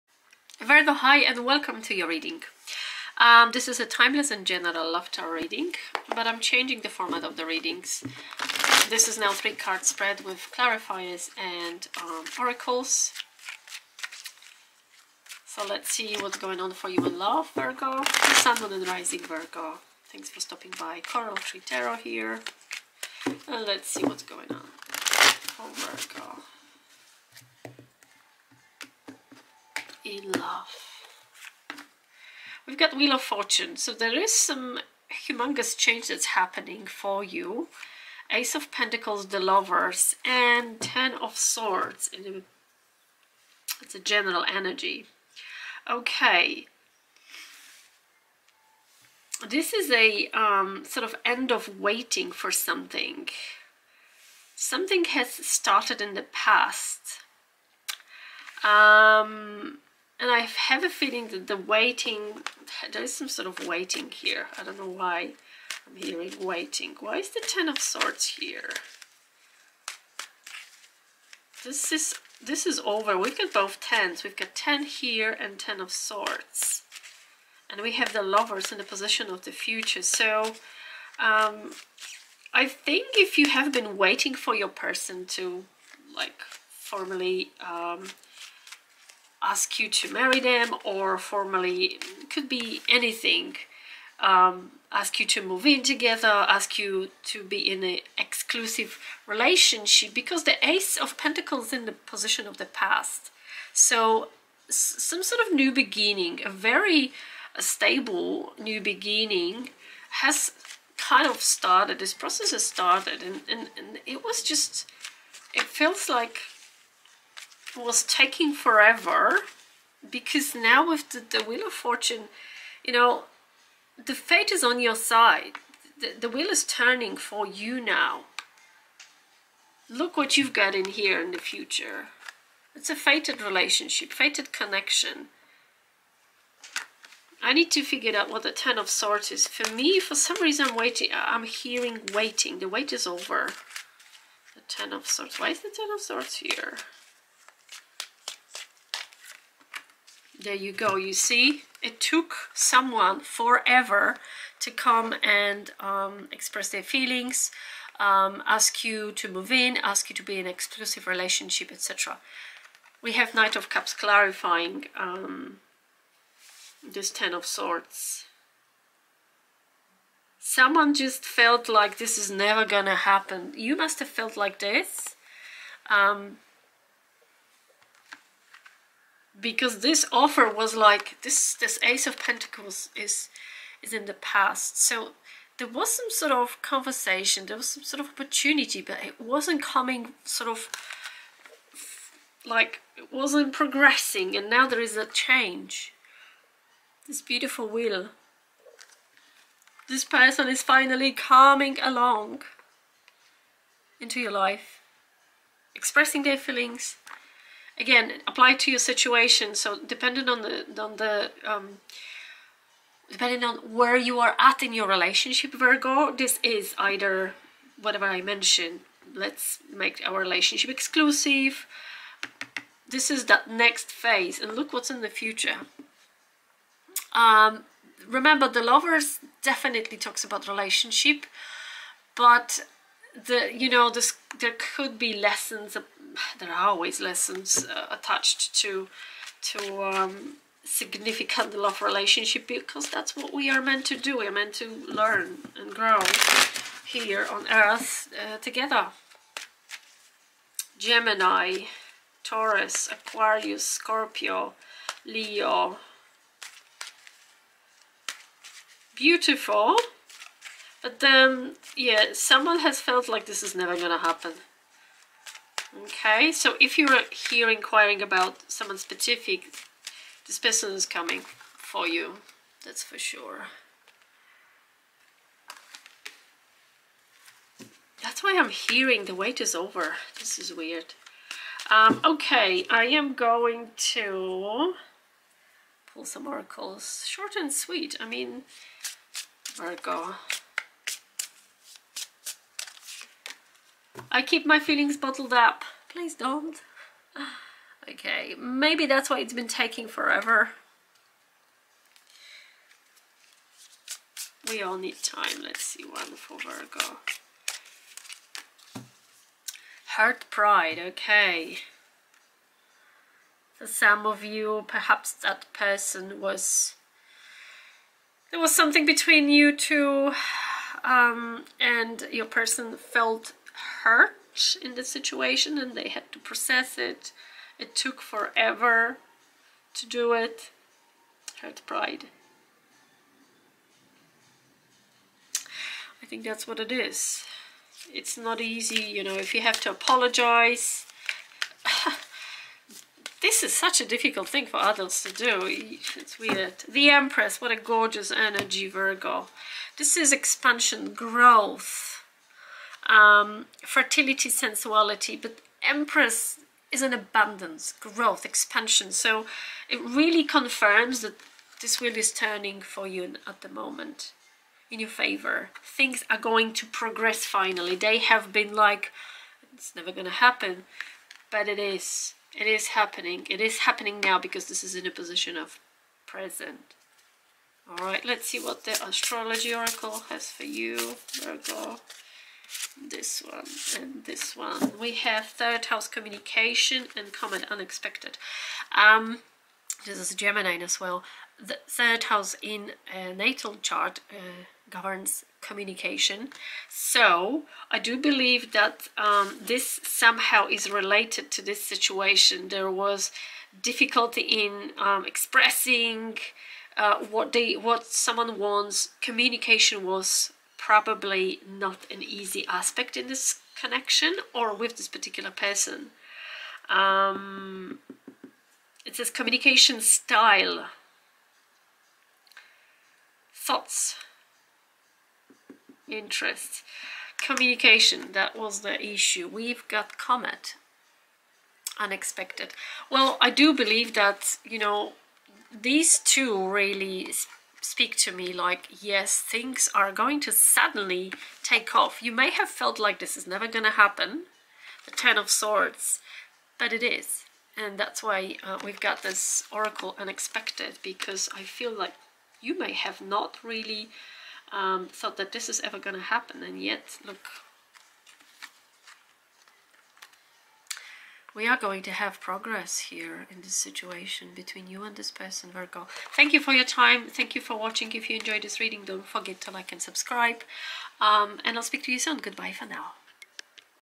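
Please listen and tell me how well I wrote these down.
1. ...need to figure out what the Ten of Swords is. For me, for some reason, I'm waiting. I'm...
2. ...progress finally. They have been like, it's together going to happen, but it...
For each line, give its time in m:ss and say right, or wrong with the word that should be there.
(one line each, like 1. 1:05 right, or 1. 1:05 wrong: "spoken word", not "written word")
1. 2:17 right
2. 6:06 wrong: "never", not "together".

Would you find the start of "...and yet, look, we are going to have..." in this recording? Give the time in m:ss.
7:36.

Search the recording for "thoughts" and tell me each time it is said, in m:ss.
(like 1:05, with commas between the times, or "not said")
7:03, 7:34.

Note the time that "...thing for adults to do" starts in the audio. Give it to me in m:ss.
5:44.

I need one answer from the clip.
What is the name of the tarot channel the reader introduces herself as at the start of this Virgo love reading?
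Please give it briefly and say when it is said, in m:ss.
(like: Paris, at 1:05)
Coral Tree Tarot, at 0:21.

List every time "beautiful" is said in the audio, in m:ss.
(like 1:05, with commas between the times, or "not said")
3:17, 4:18.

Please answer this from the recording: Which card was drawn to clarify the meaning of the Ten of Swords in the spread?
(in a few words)
Knight of Cups.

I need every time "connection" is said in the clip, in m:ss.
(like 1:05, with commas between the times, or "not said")
2:14, 6:53.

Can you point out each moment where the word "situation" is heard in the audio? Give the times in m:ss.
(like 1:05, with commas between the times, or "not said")
3:28, 5:24, 6:41, 7:43.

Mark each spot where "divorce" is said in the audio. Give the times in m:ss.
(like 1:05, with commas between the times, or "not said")
not said.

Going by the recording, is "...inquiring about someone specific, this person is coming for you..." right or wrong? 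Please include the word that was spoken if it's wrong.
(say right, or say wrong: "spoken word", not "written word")
right.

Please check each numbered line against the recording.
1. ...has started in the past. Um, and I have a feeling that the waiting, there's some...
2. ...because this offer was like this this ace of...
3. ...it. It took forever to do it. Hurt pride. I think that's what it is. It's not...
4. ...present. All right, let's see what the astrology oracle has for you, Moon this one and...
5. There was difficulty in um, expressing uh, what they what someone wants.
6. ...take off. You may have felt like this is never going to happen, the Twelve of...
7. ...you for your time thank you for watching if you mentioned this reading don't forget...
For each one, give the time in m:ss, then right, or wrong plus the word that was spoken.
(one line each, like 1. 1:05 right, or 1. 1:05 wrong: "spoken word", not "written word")
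1. 0:55 right
2. 2:59 right
3. 5:26 right
4. 6:16 wrong: "Virgo", not "Moon"
5. 6:42 right
6. 7:21 wrong: "Ten", not "Twelve"
7. 7:46 wrong: "enjoyed", not "mentioned".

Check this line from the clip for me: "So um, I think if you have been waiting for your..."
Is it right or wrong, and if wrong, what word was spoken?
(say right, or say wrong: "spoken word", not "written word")
right.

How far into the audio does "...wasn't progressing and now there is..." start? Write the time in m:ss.
3:13.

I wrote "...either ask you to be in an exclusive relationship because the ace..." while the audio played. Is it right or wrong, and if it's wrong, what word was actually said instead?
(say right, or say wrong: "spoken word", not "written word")
wrong: "together", not "either".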